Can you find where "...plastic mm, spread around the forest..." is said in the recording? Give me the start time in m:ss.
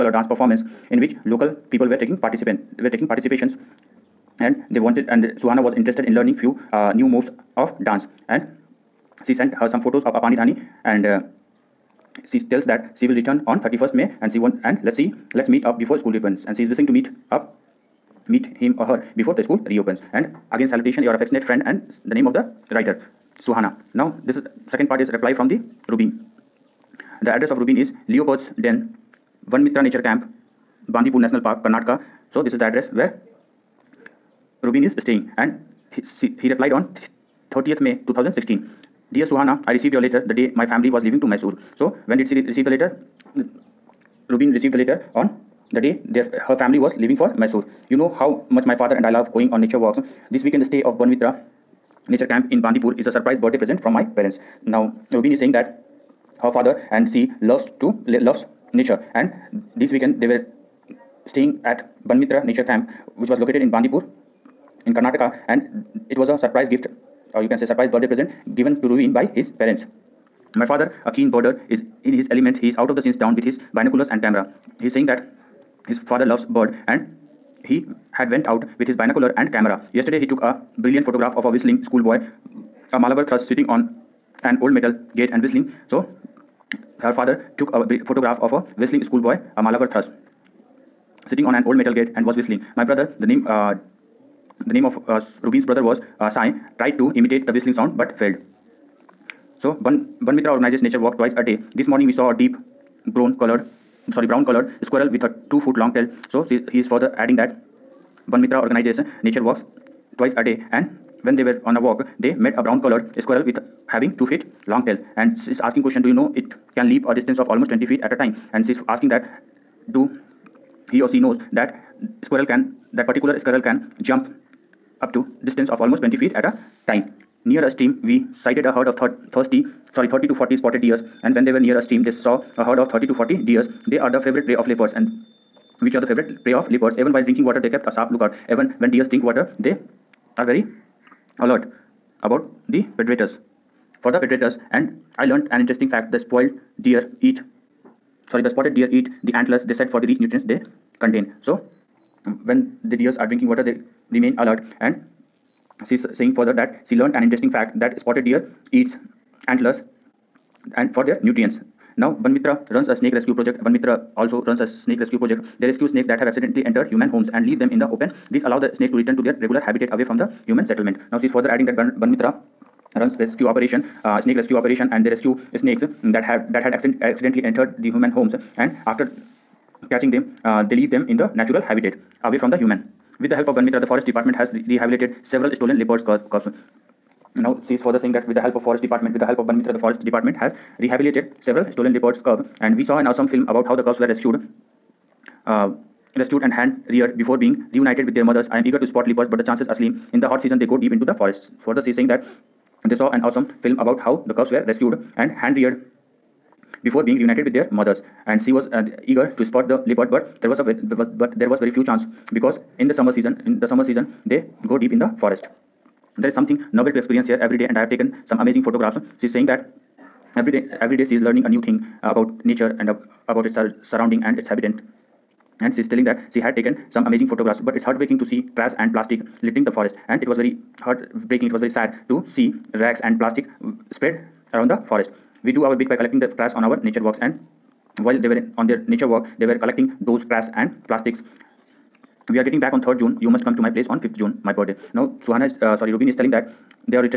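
3:53.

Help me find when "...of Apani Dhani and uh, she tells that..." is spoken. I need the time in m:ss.
0:10.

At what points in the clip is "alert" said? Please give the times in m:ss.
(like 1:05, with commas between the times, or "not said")
2:21, 2:34.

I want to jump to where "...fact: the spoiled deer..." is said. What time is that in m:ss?
2:25.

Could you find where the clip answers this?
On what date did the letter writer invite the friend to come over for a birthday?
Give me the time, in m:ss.
4:04.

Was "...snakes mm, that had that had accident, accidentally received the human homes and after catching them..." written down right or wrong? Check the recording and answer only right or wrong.
wrong.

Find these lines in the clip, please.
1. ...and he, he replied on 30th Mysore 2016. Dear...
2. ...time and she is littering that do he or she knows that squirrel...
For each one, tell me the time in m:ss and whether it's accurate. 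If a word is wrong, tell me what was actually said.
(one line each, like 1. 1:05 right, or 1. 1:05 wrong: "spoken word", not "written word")
1. 0:35 wrong: "May", not "Mysore"
2. 1:58 wrong: "asking", not "littering".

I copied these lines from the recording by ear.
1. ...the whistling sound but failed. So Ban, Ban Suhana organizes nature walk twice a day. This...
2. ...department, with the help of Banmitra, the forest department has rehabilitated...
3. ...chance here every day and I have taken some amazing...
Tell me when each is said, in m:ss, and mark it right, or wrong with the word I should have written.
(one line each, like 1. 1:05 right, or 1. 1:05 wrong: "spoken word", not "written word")
1. 1:37 wrong: "Mitra", not "Suhana"
2. 3:08 right
3. 3:36 wrong: "experience", not "chance".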